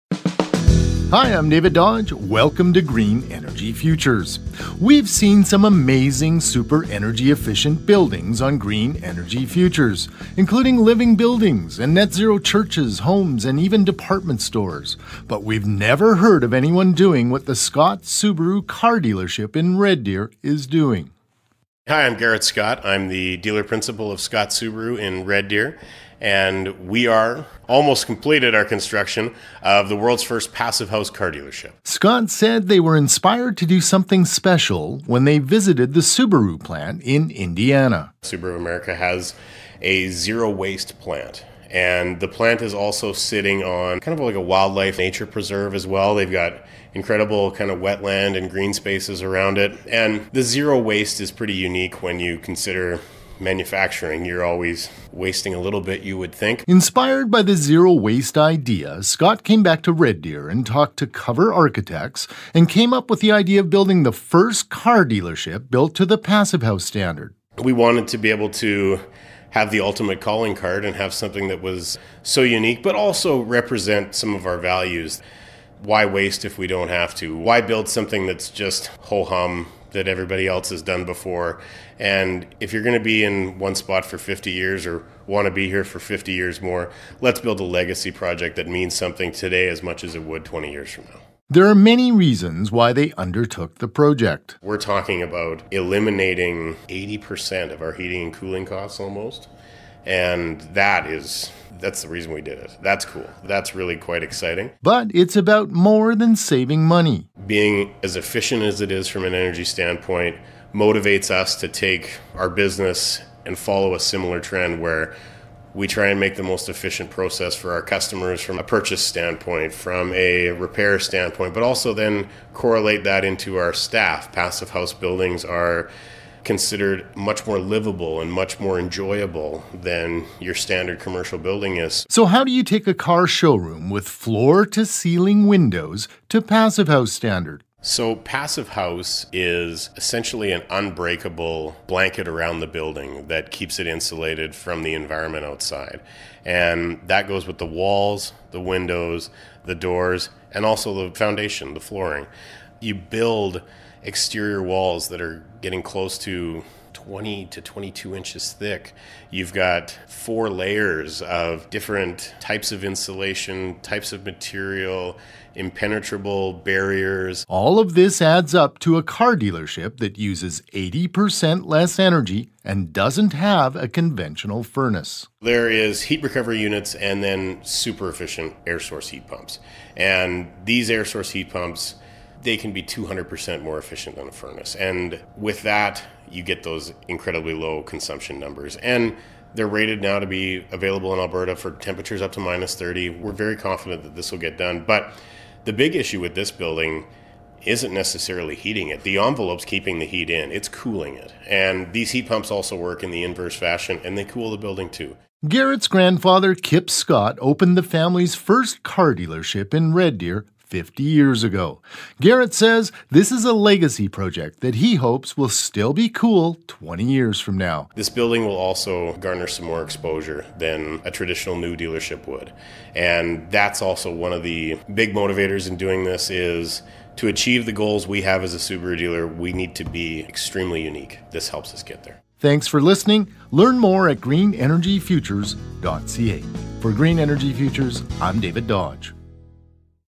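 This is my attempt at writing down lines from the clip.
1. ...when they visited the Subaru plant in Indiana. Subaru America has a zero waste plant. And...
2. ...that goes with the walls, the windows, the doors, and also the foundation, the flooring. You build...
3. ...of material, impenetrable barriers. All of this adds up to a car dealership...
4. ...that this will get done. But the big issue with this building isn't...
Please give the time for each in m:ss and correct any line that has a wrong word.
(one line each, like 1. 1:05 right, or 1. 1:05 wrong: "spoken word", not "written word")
1. 0:35 right
2. 2:27 right
3. 2:44 right
4. 3:14 right.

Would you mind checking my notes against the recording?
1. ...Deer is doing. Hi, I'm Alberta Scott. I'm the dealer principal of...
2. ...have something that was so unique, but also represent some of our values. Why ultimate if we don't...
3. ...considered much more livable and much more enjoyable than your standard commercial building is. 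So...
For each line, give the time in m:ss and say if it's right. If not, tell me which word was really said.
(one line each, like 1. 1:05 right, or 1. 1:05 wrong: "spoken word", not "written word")
1. 0:20 wrong: "Garrett", not "Alberta"
2. 1:10 wrong: "waste", not "ultimate"
3. 2:06 right.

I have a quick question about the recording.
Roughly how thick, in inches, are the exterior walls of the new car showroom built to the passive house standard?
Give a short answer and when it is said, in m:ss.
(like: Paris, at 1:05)
20 to 22 inches, at 2:37.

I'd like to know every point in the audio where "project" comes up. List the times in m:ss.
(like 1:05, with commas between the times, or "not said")
1:28, 1:33, 3:34.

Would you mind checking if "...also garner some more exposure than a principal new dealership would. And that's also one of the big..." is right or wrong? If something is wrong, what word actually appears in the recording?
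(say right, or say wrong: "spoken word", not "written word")
wrong: "traditional", not "principal".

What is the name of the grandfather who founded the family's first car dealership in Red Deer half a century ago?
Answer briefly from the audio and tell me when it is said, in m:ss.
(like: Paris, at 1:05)
Kip Scott, at 3:26.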